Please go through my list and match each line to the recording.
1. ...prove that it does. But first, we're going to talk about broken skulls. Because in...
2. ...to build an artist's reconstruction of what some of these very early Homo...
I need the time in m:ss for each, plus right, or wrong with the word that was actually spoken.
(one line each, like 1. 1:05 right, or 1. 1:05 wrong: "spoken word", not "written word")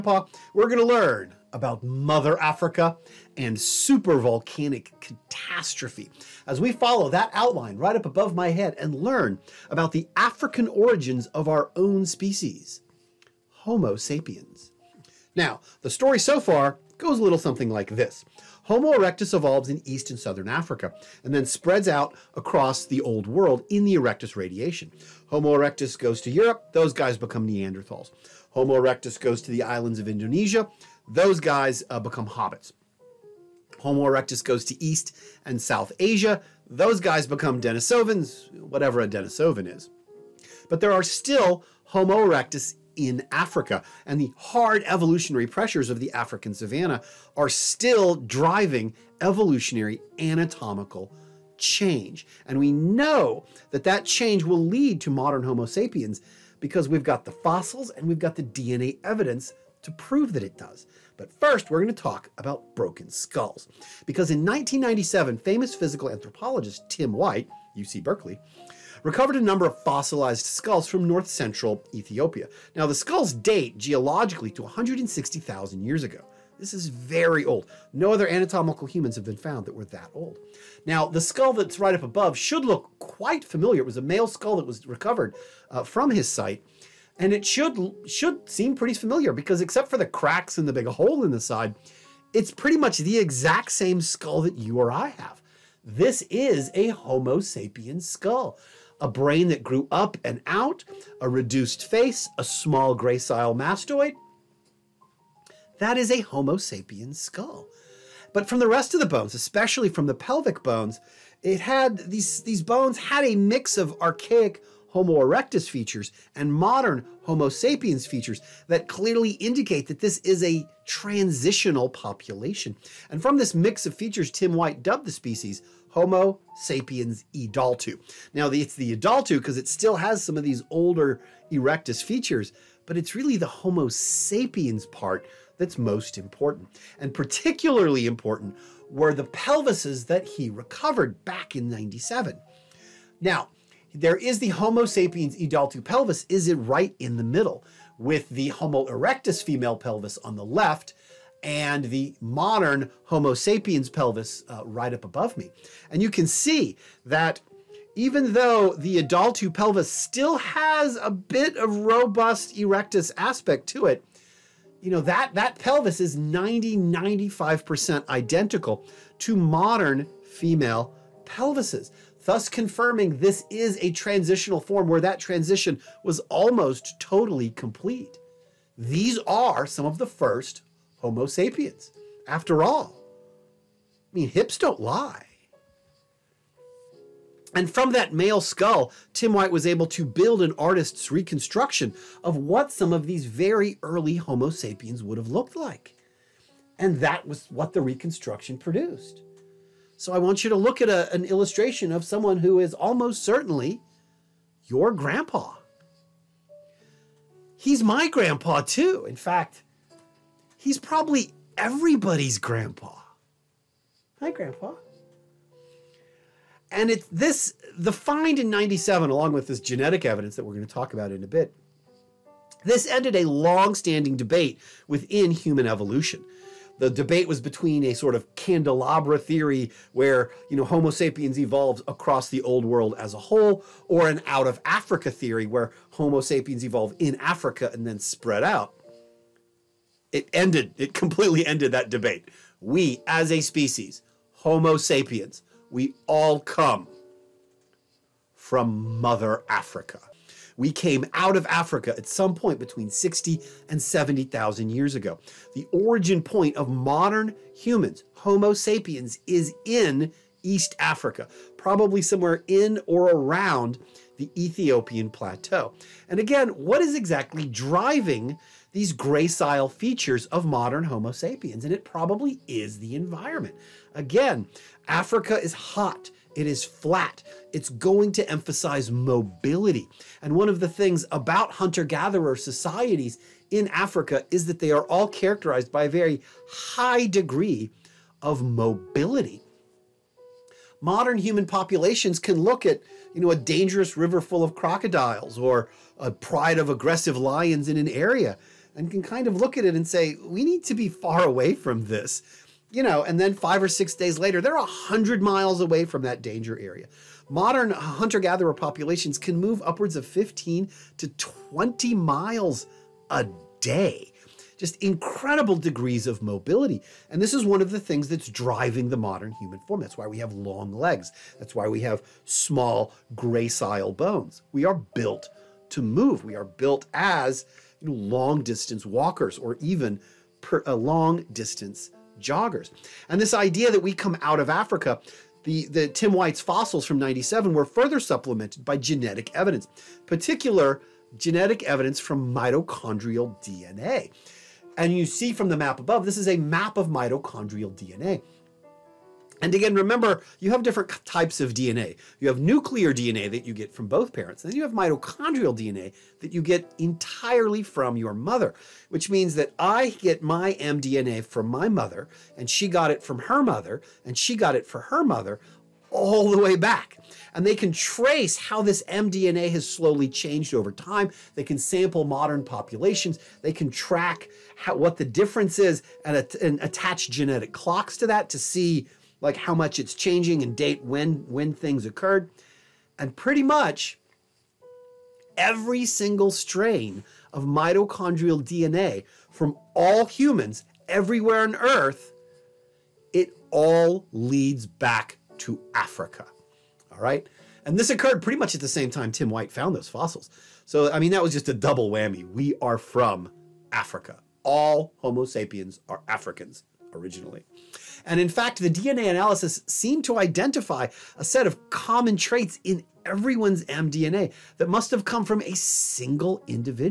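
1. 0:59 right
2. 3:09 right.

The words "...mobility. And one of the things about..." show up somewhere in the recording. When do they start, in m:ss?
4:38.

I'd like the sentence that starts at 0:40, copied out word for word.
But there are still Homo erectus in Africa.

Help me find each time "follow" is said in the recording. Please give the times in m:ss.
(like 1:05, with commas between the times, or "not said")
0:06.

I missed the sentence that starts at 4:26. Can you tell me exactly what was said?
And again, what is exactly driving these gracile features of modern Homo sapiens, and it probably is the environment.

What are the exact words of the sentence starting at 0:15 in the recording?
Now, the story so far goes a little something like this.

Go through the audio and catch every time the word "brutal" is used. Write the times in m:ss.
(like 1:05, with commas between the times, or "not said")
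not said.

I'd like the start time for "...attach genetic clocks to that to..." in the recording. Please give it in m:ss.
6:16.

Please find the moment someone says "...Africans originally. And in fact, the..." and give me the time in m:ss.
6:46.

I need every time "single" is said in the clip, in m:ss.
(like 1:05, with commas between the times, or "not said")
6:25, 6:55.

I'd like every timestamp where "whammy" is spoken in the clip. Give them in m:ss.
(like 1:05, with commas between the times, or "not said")
6:41.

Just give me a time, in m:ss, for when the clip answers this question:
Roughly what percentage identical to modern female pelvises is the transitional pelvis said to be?
2:46.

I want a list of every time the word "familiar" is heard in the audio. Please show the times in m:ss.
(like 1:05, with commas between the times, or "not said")
1:23, 1:28.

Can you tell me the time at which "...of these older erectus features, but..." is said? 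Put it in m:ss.
2:10.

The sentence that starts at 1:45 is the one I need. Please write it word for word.
That is a Homo sapiens skull.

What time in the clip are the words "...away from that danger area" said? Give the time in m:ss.
5:05.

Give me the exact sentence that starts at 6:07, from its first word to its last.
And they can trace how this mDNA has slowly changed over time.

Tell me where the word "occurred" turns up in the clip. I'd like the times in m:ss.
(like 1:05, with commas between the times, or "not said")
6:21, 6:37.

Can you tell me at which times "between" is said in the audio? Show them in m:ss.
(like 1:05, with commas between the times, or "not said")
3:47, 4:12.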